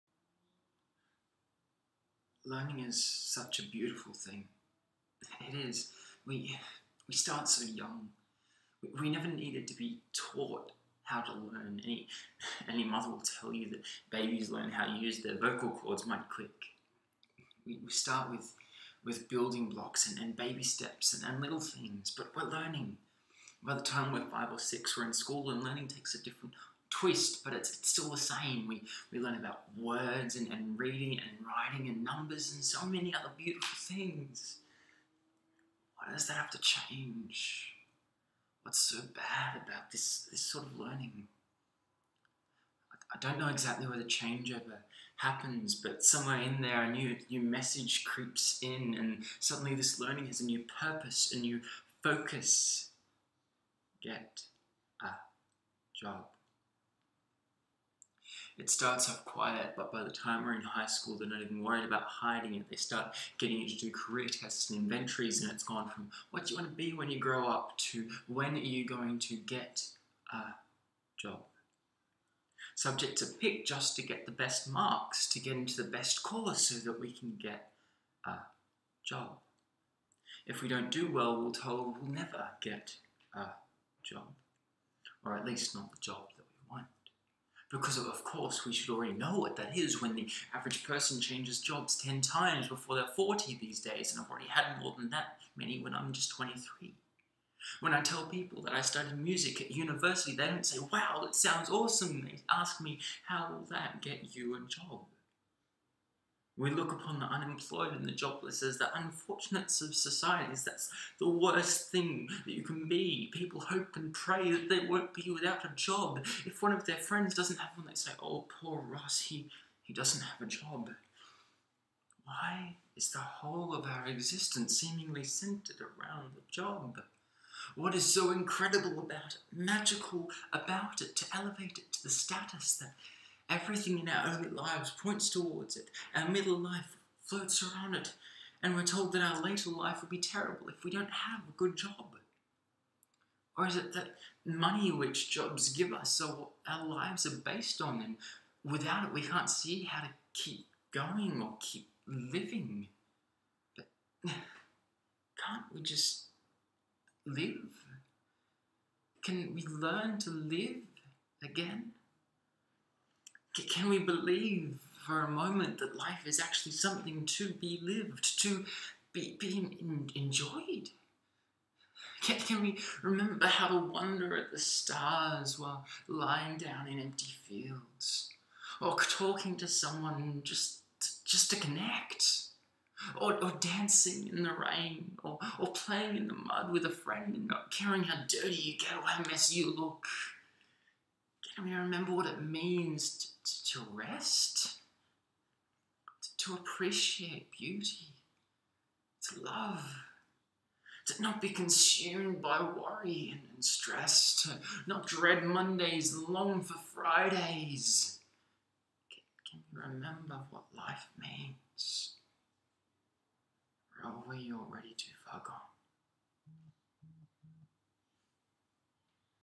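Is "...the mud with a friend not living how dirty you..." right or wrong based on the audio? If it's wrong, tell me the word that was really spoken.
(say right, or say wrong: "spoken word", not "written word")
wrong: "caring", not "living".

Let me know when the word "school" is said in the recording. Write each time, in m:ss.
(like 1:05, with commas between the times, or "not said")
0:25, 1:00.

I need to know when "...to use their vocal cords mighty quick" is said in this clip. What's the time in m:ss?
0:14.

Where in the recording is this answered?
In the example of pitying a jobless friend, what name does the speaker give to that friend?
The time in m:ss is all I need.
1:58.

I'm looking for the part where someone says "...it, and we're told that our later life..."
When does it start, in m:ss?
2:17.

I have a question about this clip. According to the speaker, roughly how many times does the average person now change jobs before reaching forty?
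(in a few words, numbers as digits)
10.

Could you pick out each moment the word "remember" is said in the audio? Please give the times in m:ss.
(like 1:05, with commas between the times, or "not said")
2:53, 3:11, 3:29.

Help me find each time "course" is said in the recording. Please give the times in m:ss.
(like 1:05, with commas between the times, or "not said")
1:16, 1:28.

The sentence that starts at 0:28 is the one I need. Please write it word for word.
We, we learn about words and, and reading and writing and numbers and so many other beautiful things.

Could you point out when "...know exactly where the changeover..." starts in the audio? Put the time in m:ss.
0:43.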